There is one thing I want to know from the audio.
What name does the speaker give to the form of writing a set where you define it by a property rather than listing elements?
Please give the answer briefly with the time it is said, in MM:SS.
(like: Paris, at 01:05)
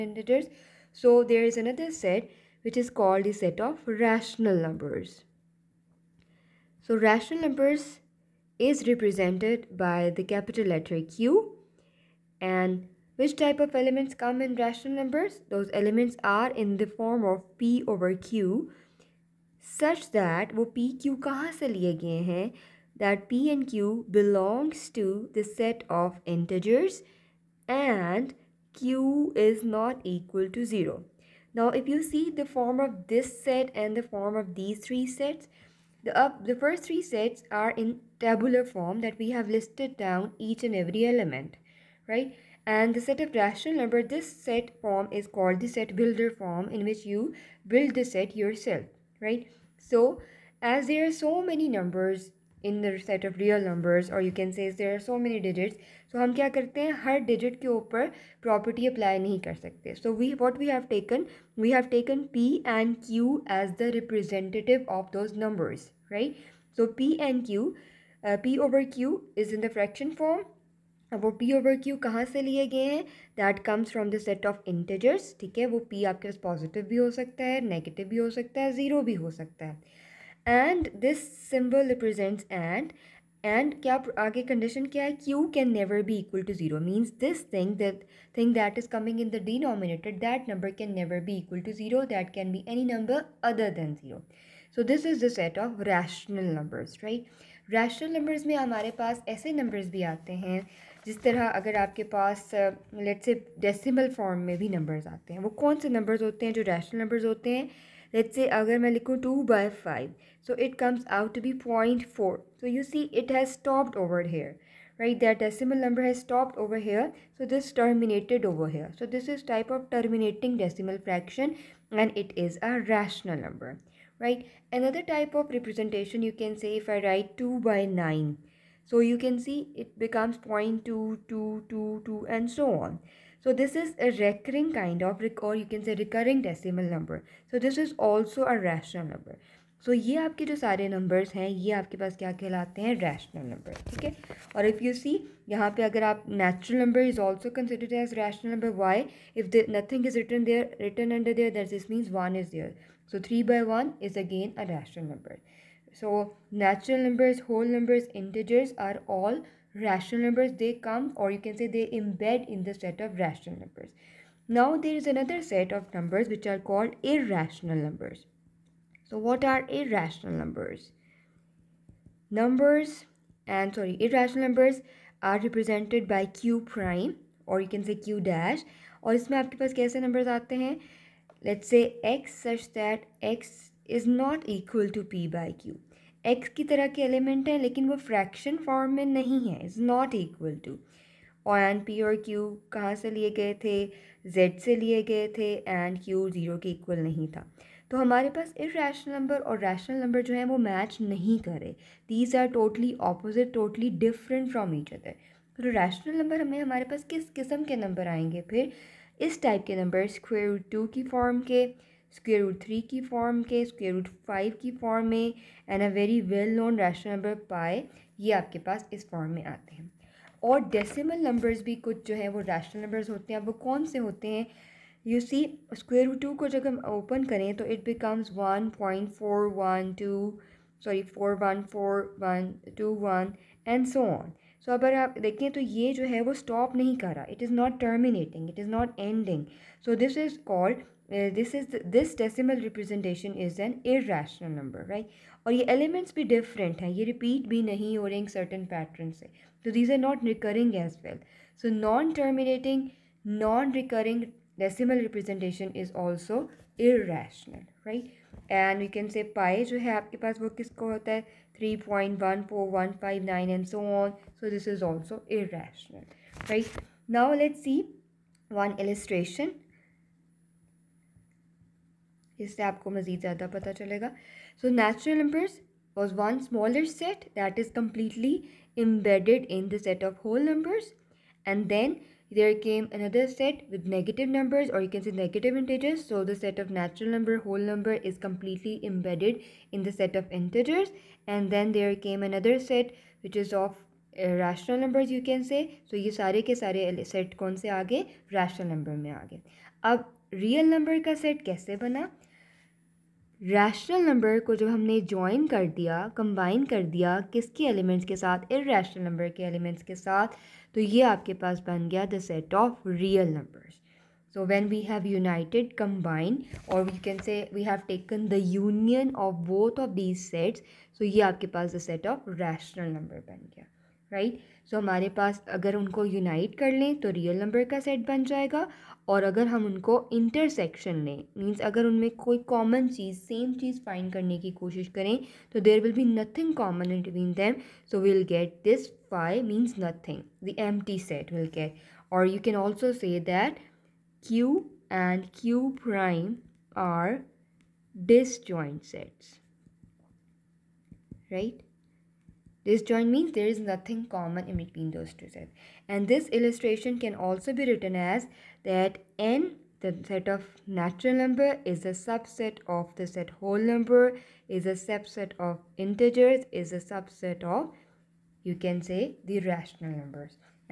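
set builder form, at 00:45.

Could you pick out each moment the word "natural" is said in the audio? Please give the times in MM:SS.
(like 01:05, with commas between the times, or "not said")
02:36, 04:46, 06:00.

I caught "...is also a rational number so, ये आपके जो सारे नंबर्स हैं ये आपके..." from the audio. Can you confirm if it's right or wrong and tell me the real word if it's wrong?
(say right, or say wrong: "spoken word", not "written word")
right.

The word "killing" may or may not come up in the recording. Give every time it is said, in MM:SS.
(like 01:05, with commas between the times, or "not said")
not said.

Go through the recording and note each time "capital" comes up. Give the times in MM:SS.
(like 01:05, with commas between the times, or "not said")
00:10.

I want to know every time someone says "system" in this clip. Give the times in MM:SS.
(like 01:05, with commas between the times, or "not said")
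not said.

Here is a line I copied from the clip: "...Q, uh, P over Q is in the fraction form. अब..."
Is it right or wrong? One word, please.
right.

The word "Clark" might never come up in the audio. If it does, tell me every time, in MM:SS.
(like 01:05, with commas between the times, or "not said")
not said.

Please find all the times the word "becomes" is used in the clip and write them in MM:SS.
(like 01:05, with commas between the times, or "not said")
02:10.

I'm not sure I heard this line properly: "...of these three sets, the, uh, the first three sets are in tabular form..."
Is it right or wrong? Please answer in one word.
right.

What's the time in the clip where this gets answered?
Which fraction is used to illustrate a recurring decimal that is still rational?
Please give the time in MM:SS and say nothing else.
02:07.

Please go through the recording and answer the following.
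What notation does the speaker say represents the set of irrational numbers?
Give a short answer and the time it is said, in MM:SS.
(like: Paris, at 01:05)
Q prime, at 02:56.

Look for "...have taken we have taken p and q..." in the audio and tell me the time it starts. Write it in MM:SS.
01:00.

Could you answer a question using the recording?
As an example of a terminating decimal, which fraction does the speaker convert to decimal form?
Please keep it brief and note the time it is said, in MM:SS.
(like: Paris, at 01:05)
2/5, at 01:49.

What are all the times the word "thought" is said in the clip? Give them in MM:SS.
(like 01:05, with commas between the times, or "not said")
not said.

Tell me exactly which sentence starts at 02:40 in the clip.
They come or you can say they embed in the set of rational numbers.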